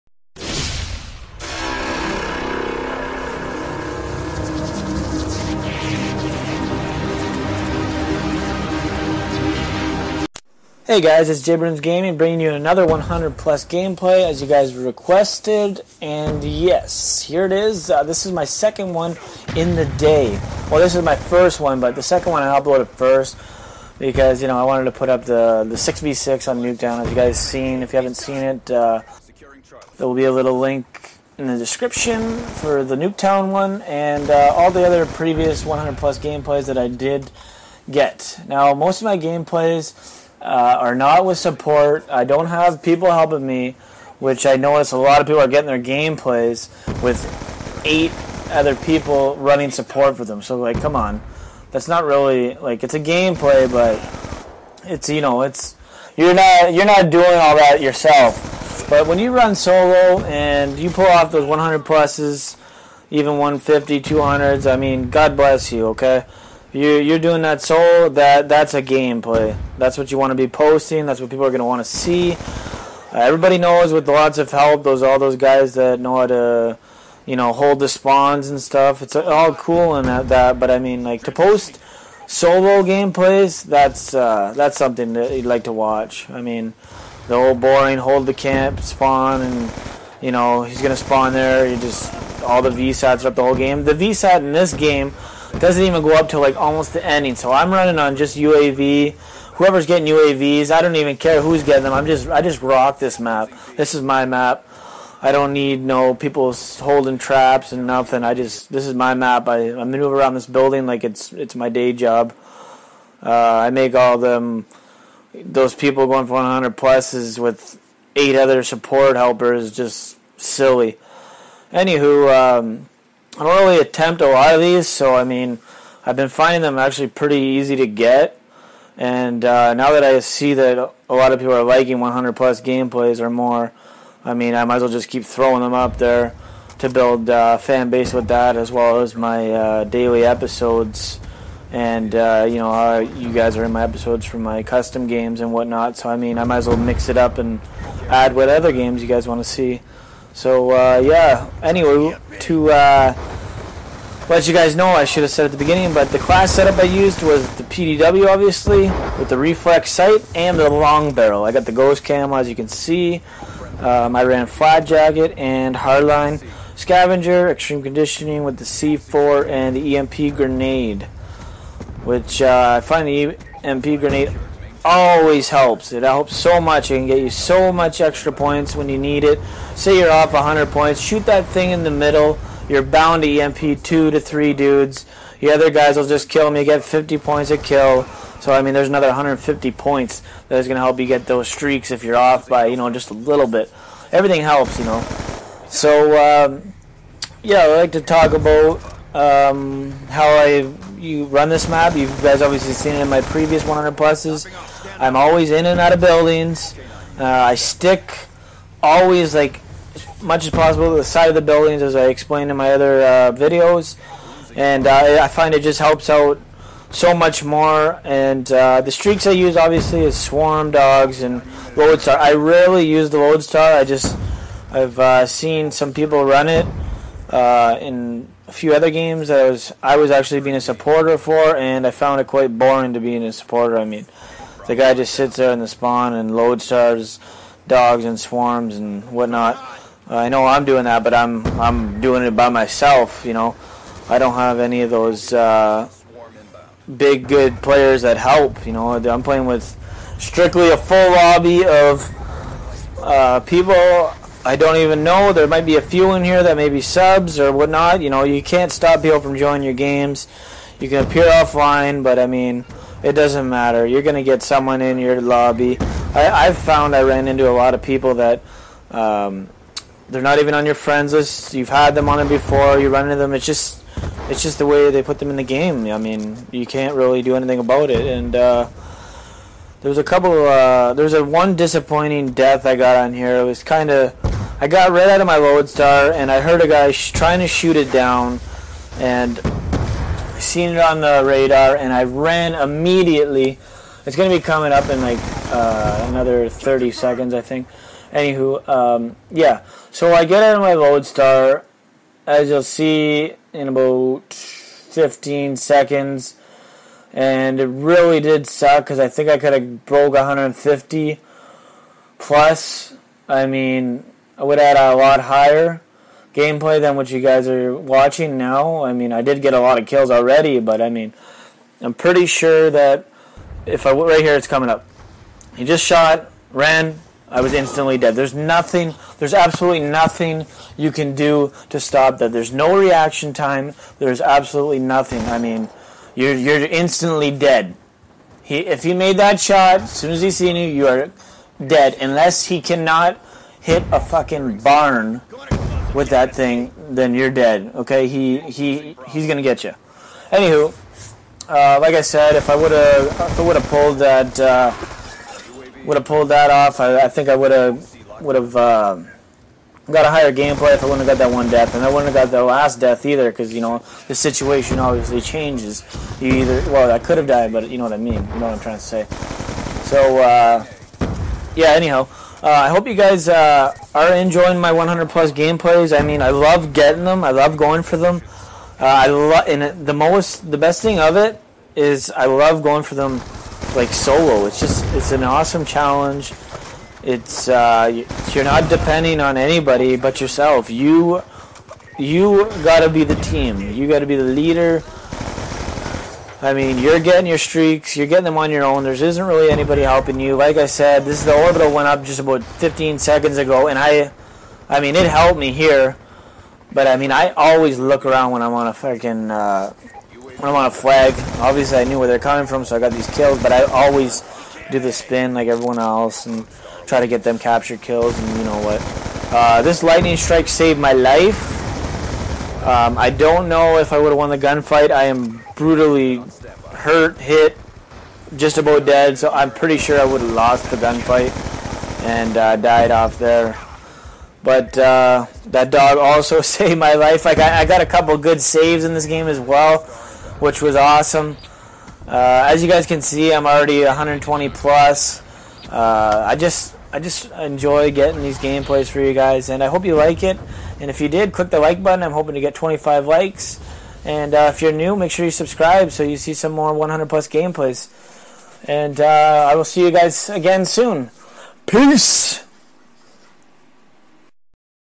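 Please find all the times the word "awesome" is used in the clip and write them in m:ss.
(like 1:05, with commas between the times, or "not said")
6:25, 7:20.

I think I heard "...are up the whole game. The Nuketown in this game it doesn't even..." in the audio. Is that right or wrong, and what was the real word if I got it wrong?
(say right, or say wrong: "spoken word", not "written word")
wrong: "VSAT", not "Nuketown".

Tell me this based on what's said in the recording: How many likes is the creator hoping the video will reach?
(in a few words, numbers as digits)
25.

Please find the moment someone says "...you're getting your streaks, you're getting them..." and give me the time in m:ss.
6:36.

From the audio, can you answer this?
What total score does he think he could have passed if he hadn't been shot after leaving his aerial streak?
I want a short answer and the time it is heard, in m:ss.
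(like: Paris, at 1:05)
150, at 5:10.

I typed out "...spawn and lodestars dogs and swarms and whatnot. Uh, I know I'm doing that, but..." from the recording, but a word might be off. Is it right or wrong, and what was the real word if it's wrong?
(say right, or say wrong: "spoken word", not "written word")
right.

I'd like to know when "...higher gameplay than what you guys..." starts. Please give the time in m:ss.
5:15.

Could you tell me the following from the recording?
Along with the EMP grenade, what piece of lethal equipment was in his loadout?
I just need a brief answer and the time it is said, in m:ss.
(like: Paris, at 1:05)
C4, at 2:48.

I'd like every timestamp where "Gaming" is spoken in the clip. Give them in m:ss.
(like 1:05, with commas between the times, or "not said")
0:11.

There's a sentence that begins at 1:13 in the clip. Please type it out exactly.
Uh, everybody knows with lots of help, those all those guys that know how to, you know, hold the spawns and stuff.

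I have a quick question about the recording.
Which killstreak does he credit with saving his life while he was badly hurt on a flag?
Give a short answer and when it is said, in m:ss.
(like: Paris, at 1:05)
lightning strike, at 6:59.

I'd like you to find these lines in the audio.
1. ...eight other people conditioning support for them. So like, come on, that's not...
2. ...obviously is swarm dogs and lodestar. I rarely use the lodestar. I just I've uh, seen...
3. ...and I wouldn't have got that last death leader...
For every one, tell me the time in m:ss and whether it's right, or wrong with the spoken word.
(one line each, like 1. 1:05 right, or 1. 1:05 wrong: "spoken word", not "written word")
1. 0:47 wrong: "running", not "conditioning"
2. 3:39 right
3. 6:01 wrong: "either", not "leader".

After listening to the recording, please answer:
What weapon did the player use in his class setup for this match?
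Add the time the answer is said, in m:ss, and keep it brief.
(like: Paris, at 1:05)
PDW, at 2:37.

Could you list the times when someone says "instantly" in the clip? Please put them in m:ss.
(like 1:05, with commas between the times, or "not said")
5:27, 5:36.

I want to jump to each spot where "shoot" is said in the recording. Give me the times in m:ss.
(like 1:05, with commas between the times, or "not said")
3:00, 4:47.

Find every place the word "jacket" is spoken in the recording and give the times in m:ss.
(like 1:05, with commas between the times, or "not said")
2:44.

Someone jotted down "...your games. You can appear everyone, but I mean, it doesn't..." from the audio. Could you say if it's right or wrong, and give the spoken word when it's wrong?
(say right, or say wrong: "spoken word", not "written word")
wrong: "offline", not "everyone".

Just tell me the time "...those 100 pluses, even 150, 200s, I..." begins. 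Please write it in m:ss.
1:01.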